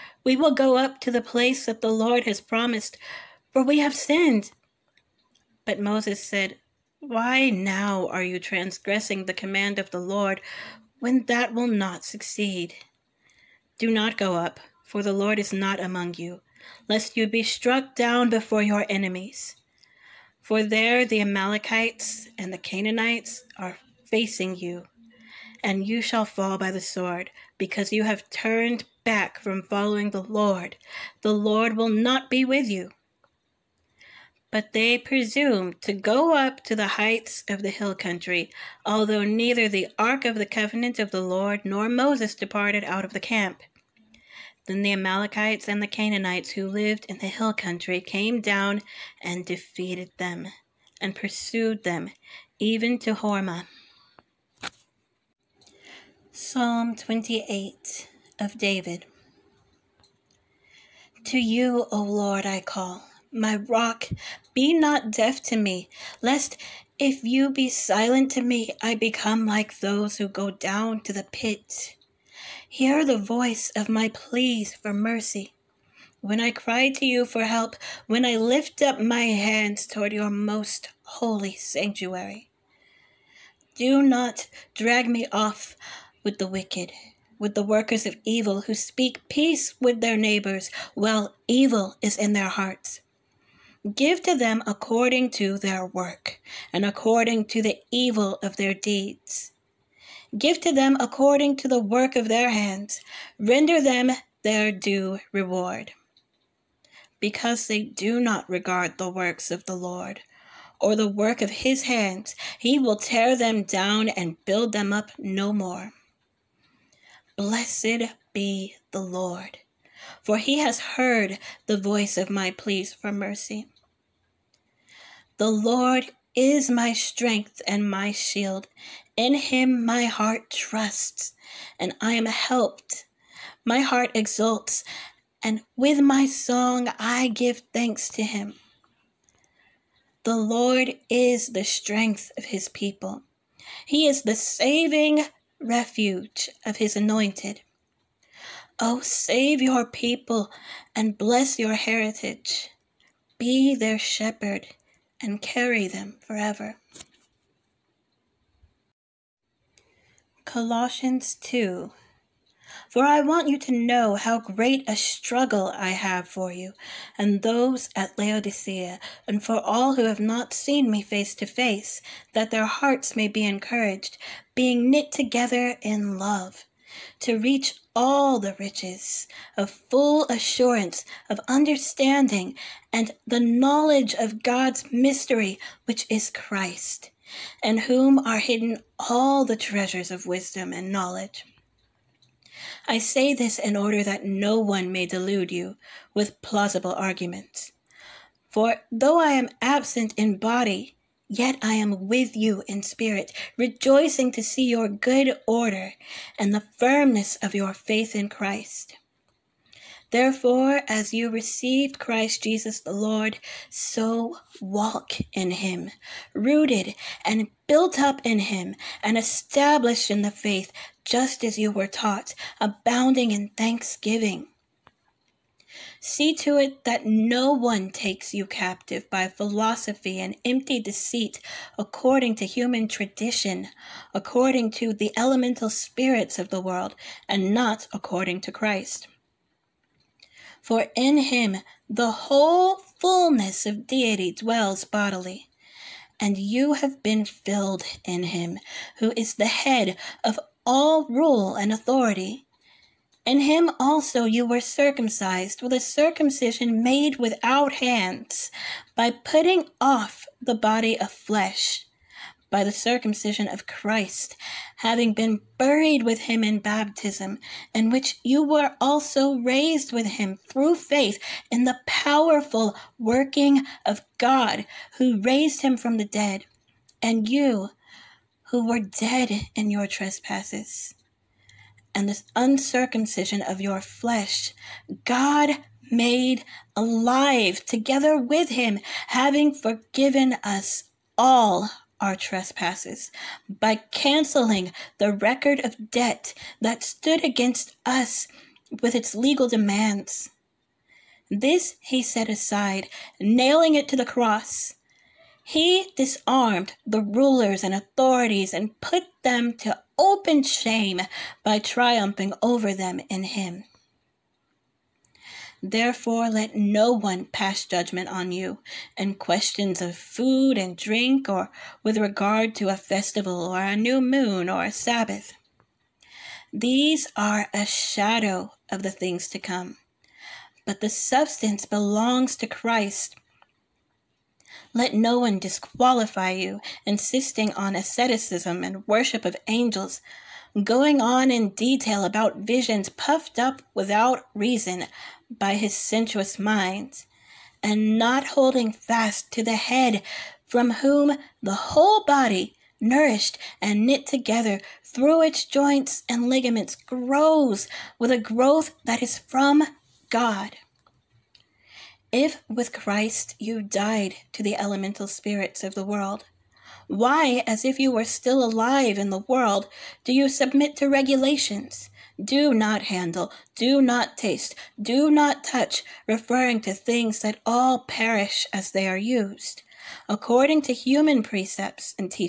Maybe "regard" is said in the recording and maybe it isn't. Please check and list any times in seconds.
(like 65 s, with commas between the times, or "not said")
108 s, 321 s.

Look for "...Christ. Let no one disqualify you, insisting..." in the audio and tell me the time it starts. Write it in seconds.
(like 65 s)
332 s.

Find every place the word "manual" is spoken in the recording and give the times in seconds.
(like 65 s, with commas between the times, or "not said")
not said.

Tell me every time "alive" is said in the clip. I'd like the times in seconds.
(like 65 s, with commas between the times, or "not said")
286 s, 368 s.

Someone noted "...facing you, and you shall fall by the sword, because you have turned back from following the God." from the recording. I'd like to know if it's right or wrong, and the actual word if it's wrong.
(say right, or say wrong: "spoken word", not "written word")
wrong: "Lord", not "God".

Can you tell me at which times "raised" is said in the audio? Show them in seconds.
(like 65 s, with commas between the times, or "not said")
269 s, 275 s.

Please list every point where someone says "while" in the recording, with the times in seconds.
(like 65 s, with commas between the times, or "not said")
90 s.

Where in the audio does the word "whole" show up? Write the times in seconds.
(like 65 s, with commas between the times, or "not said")
242 s, 351 s.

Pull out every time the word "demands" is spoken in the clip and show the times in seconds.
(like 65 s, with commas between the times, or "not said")
299 s.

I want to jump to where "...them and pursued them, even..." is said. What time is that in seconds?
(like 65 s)
50 s.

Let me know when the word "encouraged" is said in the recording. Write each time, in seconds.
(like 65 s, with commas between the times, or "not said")
173 s.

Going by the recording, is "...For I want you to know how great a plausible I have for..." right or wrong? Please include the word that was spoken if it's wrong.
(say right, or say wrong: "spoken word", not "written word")
wrong: "struggle", not "plausible".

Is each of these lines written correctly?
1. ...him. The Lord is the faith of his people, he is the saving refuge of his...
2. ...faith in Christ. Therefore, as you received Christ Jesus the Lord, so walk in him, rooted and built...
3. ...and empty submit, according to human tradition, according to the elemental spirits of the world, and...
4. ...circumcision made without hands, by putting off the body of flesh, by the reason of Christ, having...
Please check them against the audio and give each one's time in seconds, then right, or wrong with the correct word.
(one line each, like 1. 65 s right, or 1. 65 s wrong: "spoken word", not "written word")
1. 138 s wrong: "strength", not "faith"
2. 207 s right
3. 230 s wrong: "deceit", not "submit"
4. 255 s wrong: "circumcision", not "reason".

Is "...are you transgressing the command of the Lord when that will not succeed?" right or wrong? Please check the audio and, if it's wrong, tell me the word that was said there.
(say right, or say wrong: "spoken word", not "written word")
right.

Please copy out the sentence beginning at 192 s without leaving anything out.
I say this in order that no one may delude you with plausible arguments.